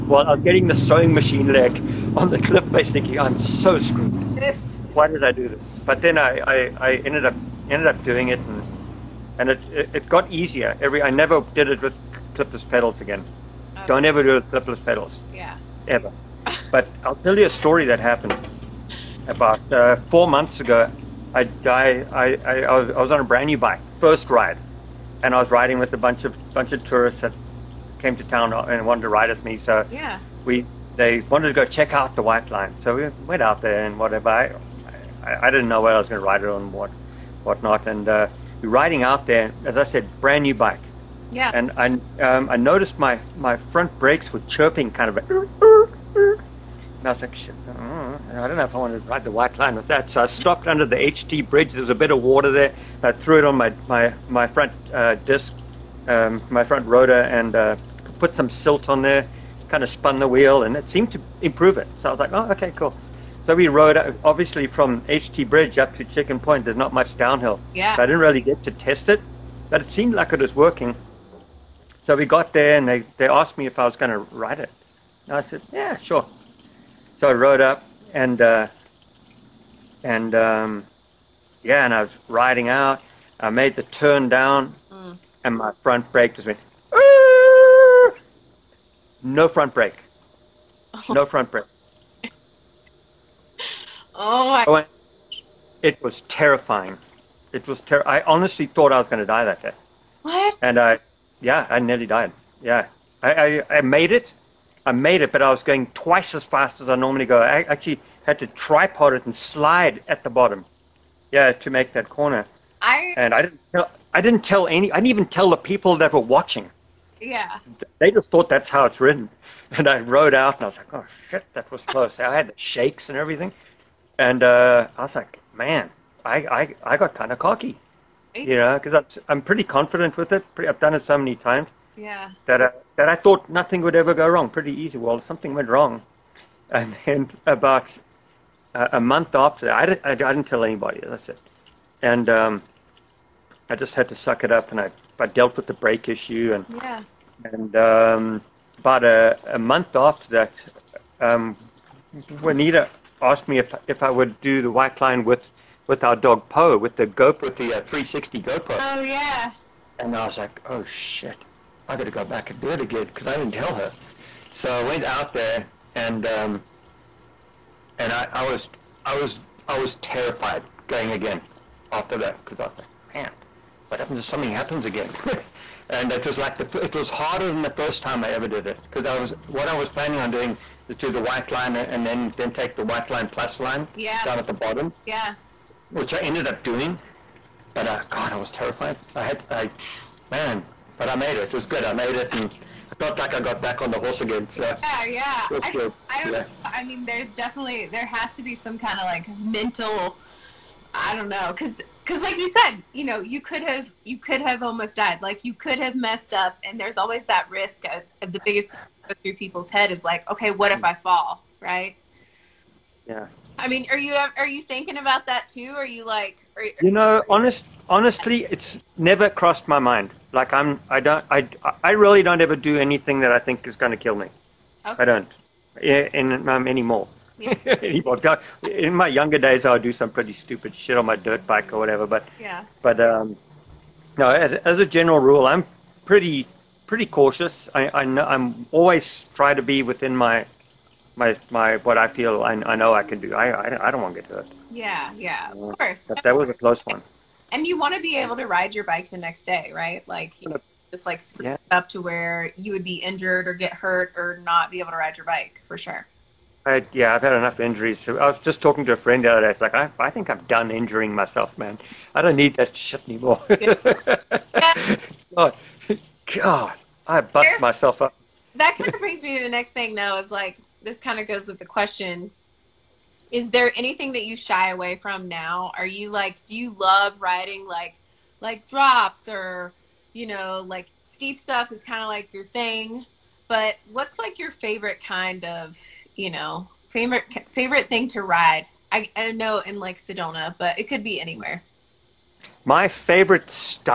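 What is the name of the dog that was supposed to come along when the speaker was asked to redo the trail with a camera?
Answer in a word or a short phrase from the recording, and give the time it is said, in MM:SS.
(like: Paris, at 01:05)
Poe, at 02:36.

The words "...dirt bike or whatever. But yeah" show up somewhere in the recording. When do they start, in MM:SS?
03:51.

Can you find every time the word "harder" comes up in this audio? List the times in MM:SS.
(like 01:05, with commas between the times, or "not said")
02:57.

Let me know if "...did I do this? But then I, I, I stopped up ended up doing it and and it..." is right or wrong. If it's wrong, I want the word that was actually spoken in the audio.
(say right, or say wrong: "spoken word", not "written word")
wrong: "ended", not "stopped".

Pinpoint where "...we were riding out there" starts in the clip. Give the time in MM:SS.
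00:38.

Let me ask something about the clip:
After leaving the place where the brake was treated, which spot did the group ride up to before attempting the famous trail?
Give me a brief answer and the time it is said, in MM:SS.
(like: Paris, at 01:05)
Chicken Point, at 01:06.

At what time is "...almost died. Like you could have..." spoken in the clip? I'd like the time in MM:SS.
03:24.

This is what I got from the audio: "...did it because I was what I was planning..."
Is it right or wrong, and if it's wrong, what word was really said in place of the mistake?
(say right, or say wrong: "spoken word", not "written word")
right.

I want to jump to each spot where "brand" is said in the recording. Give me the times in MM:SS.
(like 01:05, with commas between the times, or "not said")
00:23, 00:40.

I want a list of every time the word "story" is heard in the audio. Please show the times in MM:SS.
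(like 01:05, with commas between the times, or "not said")
00:17.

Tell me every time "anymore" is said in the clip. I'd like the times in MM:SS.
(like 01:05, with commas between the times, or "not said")
03:46, 04:23.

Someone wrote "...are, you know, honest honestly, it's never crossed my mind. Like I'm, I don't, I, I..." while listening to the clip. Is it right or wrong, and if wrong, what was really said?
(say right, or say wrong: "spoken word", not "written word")
right.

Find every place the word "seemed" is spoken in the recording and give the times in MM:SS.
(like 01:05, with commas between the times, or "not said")
01:00, 01:09.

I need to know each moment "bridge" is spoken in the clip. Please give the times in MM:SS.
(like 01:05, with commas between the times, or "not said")
00:51, 01:05.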